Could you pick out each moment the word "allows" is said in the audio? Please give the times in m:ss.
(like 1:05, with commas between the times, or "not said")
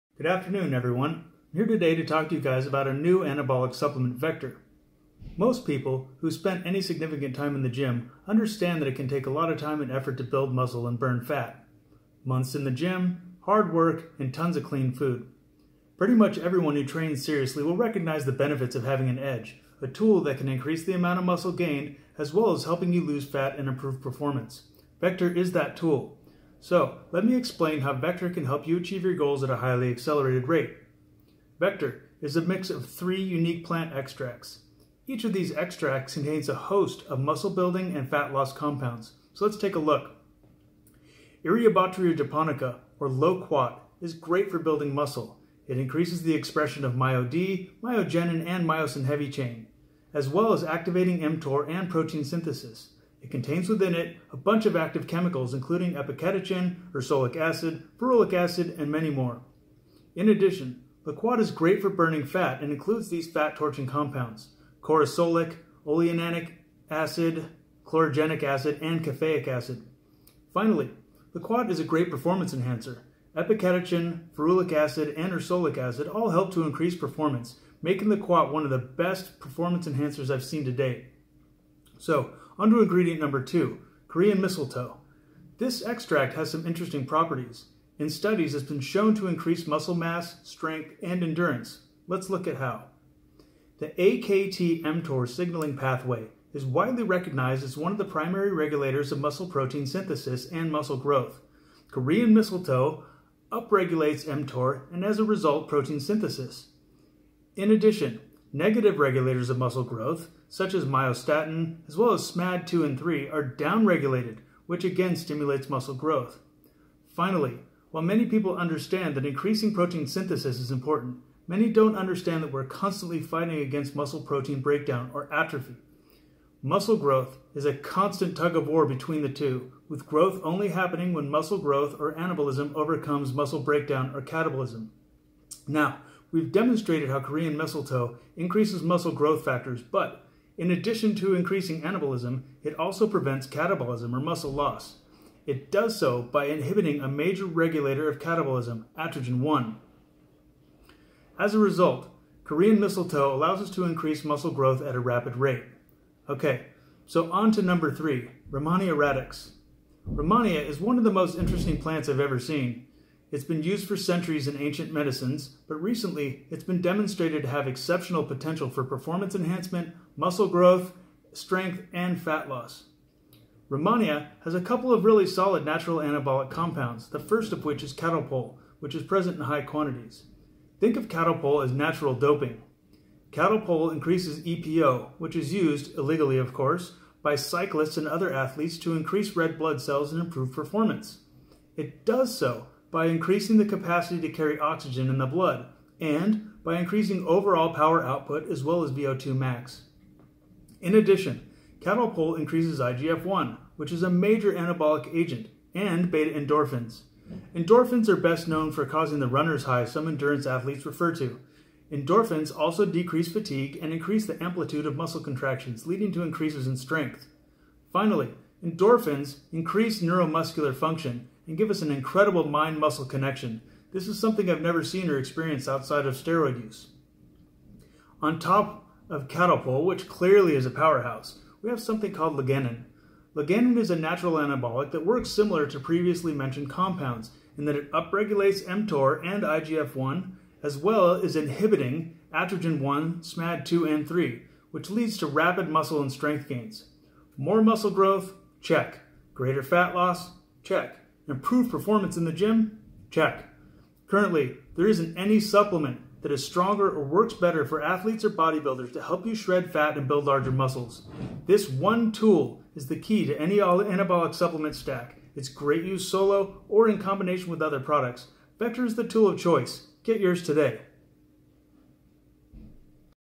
2:33.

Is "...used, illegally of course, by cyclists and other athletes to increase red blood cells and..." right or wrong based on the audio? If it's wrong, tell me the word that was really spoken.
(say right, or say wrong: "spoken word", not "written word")
right.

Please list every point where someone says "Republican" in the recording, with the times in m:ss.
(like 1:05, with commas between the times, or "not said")
not said.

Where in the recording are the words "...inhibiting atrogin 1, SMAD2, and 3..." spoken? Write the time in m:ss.
4:01.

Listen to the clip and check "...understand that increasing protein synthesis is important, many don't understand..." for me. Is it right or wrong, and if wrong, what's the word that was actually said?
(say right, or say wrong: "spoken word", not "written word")
right.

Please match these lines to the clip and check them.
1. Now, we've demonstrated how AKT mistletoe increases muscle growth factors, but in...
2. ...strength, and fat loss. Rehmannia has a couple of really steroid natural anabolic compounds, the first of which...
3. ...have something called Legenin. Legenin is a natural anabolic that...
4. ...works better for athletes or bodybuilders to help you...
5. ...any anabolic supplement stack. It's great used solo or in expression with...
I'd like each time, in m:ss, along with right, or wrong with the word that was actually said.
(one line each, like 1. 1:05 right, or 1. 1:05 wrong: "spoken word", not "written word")
1. 2:15 wrong: "Korean", not "AKT"
2. 2:51 wrong: "solid", not "steroid"
3. 3:51 right
4. 4:17 right
5. 4:23 wrong: "combination", not "expression".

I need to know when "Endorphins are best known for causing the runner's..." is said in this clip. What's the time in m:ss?
3:27.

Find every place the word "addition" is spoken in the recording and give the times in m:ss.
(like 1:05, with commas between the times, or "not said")
1:00, 1:47, 2:20, 3:20.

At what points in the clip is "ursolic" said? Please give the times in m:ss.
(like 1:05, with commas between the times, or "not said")
0:56, 1:15.